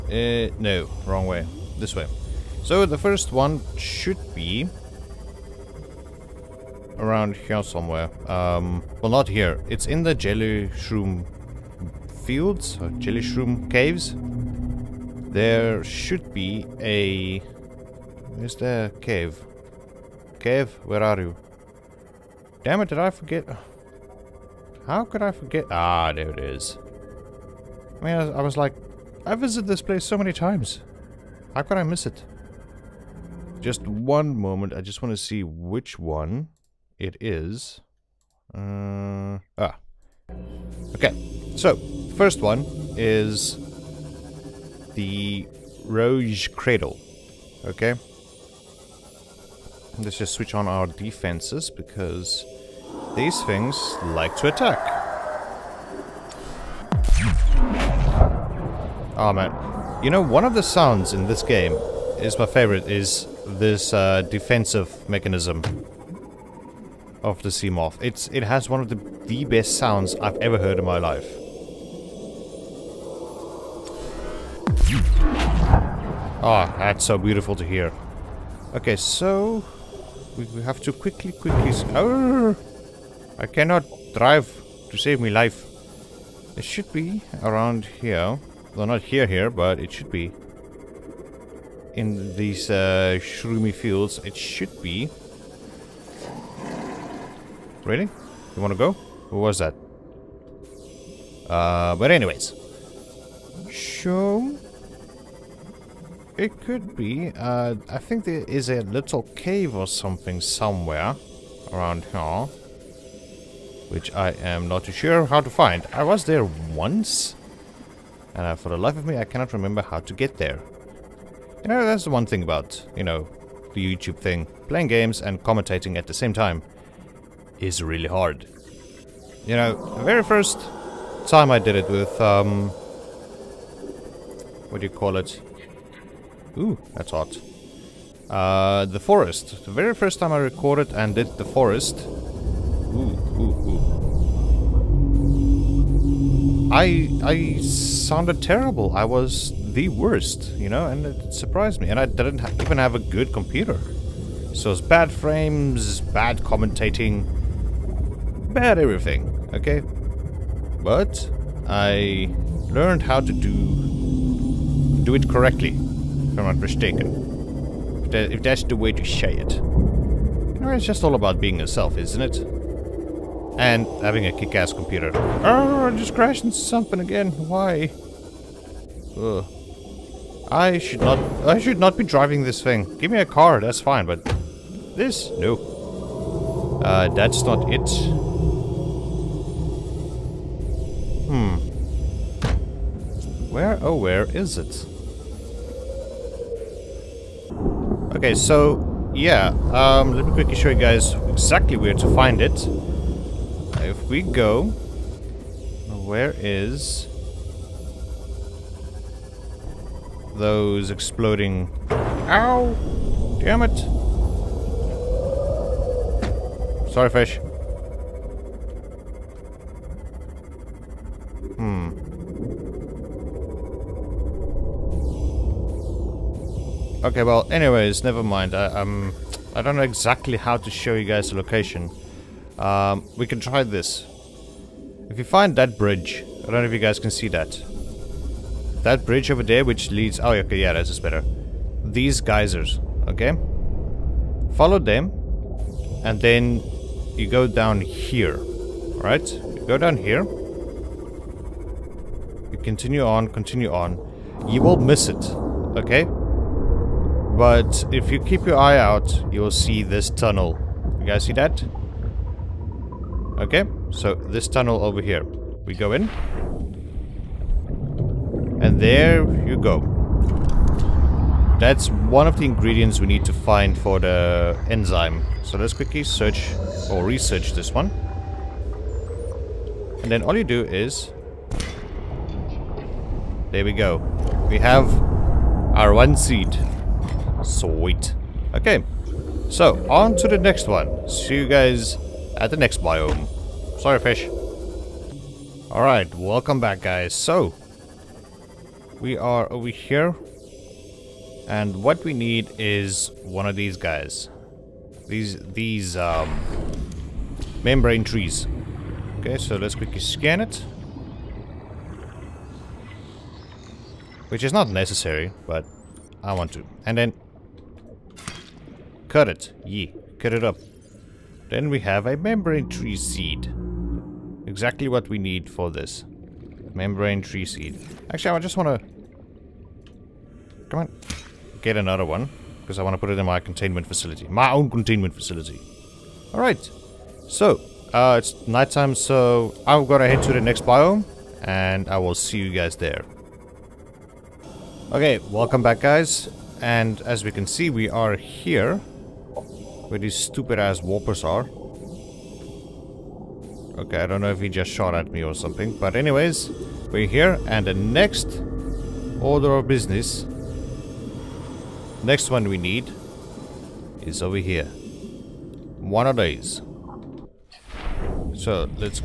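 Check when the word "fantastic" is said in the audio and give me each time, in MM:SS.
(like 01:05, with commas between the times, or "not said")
not said.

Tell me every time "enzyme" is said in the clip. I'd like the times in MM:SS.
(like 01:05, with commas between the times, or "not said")
04:34.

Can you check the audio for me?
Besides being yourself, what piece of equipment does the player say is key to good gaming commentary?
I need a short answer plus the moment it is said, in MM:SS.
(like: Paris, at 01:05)
a kick-ass computer, at 02:54.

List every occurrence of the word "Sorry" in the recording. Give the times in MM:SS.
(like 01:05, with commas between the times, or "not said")
03:36, 04:53.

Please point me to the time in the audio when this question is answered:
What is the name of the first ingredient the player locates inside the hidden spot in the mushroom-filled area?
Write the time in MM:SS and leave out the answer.
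00:45.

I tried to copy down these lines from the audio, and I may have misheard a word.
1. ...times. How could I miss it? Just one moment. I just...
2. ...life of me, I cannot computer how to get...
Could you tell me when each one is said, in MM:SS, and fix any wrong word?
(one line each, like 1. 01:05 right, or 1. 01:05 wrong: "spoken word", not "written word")
1. 00:30 right
2. 01:58 wrong: "remember", not "computer".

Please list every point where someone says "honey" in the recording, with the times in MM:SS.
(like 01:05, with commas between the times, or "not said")
not said.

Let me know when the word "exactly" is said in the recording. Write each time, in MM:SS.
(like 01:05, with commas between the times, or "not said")
03:21, 03:49, 05:24.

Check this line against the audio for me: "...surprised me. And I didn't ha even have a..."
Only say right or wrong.
right.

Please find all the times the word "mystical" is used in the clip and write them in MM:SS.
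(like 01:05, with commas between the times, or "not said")
not said.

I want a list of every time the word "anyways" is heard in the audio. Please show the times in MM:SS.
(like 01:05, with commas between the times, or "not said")
01:42, 03:47, 05:55.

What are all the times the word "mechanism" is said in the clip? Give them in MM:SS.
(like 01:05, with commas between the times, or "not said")
01:05.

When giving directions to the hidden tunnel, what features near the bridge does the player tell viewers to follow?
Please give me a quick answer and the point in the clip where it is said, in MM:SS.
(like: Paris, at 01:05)
geysers, at 04:02.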